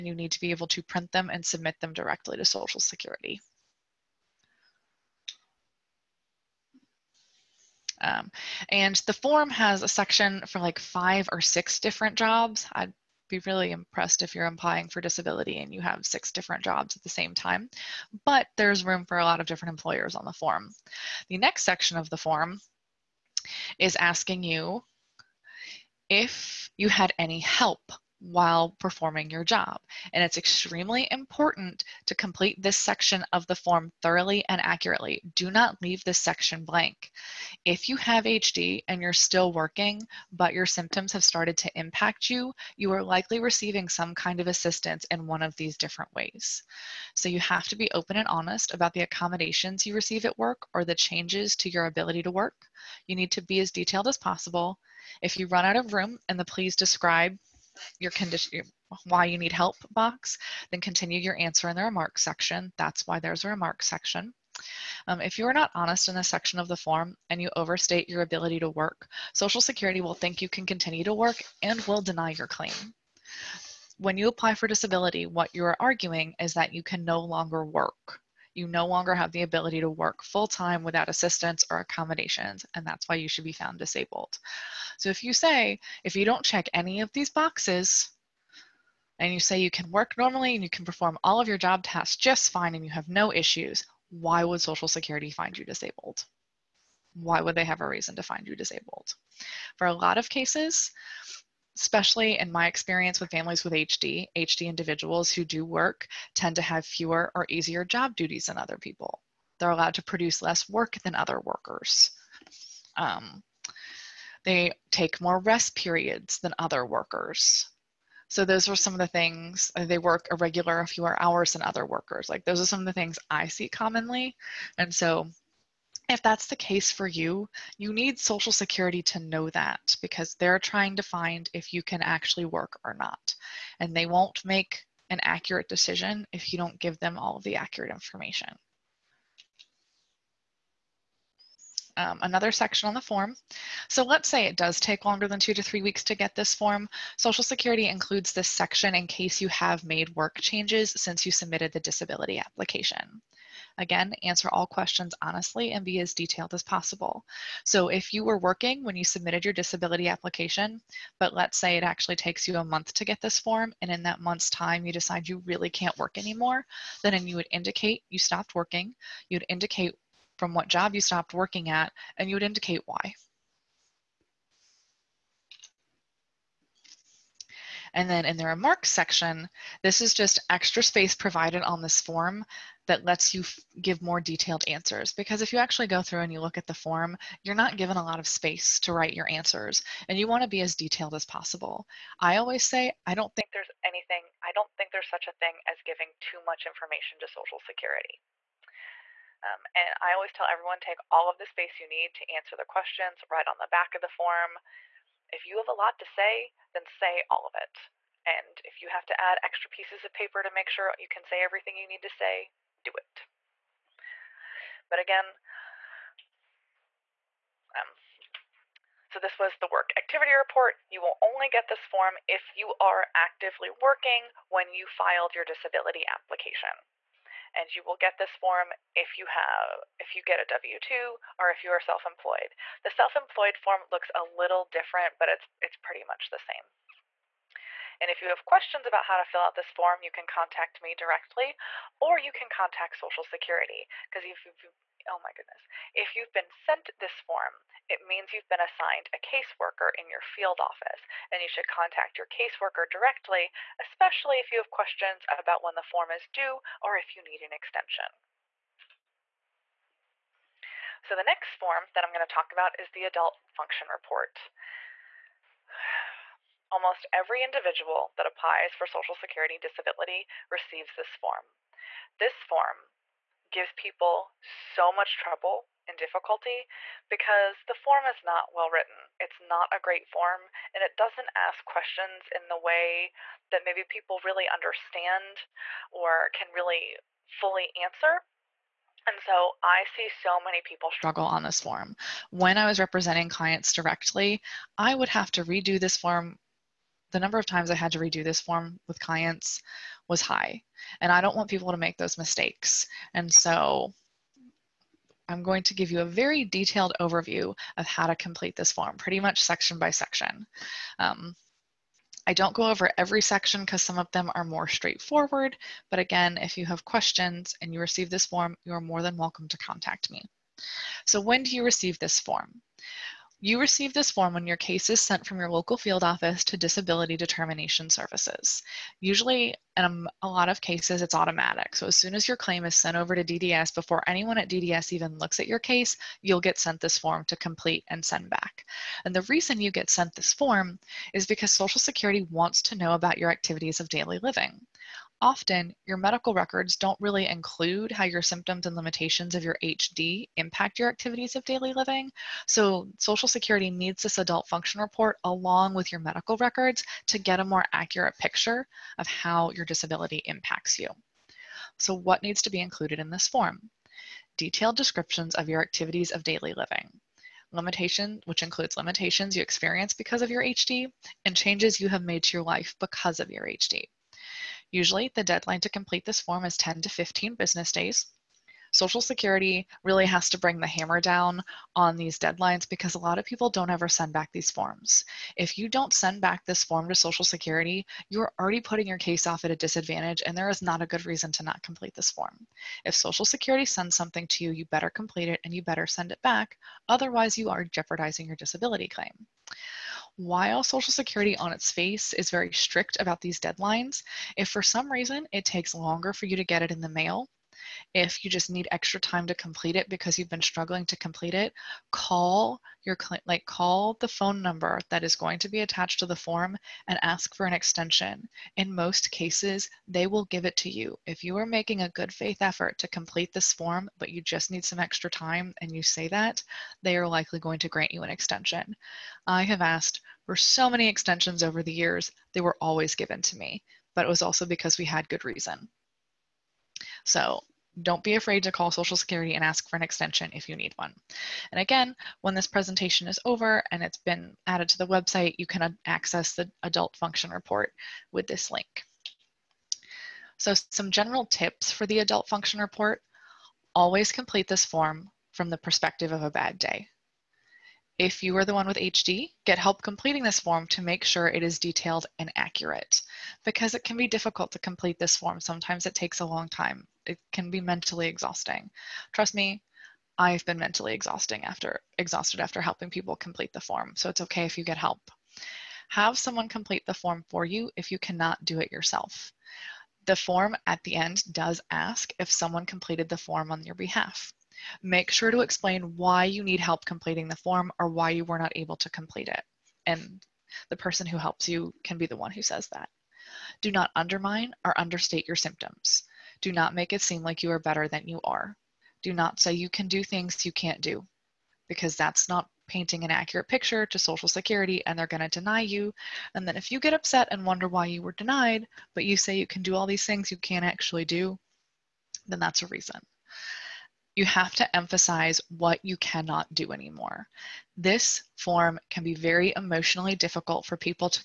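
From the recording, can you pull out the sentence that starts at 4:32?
This form gives people so much trouble and difficulty because the form is not well written.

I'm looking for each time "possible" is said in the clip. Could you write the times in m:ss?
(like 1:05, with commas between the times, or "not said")
0:54, 2:36, 3:11.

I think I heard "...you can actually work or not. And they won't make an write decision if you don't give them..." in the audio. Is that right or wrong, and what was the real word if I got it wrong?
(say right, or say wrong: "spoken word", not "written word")
wrong: "accurate", not "write".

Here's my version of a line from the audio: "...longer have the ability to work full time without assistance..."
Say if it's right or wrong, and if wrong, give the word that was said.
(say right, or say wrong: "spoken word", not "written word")
right.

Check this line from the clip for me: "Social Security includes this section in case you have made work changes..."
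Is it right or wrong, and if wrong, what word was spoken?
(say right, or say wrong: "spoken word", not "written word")
right.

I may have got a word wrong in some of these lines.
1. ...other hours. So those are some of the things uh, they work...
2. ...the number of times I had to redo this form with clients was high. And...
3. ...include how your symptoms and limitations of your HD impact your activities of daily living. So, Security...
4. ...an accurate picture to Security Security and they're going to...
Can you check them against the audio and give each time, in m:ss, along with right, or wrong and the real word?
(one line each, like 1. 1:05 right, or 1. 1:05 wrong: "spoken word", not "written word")
1. 1:56 wrong: "workers", not "hours"
2. 4:57 right
3. 5:47 wrong: "Social", not "Security"
4. 8:23 wrong: "Social", not "Security".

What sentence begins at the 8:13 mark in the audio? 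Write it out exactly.
Do not undermine or understate your symptoms.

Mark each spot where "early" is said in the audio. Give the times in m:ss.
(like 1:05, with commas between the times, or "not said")
not said.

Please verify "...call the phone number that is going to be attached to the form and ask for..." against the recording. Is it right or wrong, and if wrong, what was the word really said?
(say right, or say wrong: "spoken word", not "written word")
right.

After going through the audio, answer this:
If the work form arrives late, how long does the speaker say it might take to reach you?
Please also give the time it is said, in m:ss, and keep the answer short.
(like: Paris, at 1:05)
a month, at 2:42.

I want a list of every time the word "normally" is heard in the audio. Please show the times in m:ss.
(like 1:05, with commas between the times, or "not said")
1:30.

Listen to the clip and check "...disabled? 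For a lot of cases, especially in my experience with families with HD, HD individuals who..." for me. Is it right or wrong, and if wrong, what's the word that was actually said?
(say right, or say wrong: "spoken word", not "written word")
right.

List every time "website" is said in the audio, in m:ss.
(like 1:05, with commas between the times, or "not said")
7:24.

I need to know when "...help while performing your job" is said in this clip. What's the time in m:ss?
0:27.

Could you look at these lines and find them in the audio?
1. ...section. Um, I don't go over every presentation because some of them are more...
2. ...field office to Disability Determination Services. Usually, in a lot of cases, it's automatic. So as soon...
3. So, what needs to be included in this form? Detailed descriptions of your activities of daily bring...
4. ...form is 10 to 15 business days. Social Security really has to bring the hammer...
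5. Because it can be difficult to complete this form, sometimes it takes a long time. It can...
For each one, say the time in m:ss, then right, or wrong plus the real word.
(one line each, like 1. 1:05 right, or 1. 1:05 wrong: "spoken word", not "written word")
1. 5:09 wrong: "section", not "presentation"
2. 5:25 right
3. 6:01 wrong: "living", not "bring"
4. 6:16 right
5. 7:43 right.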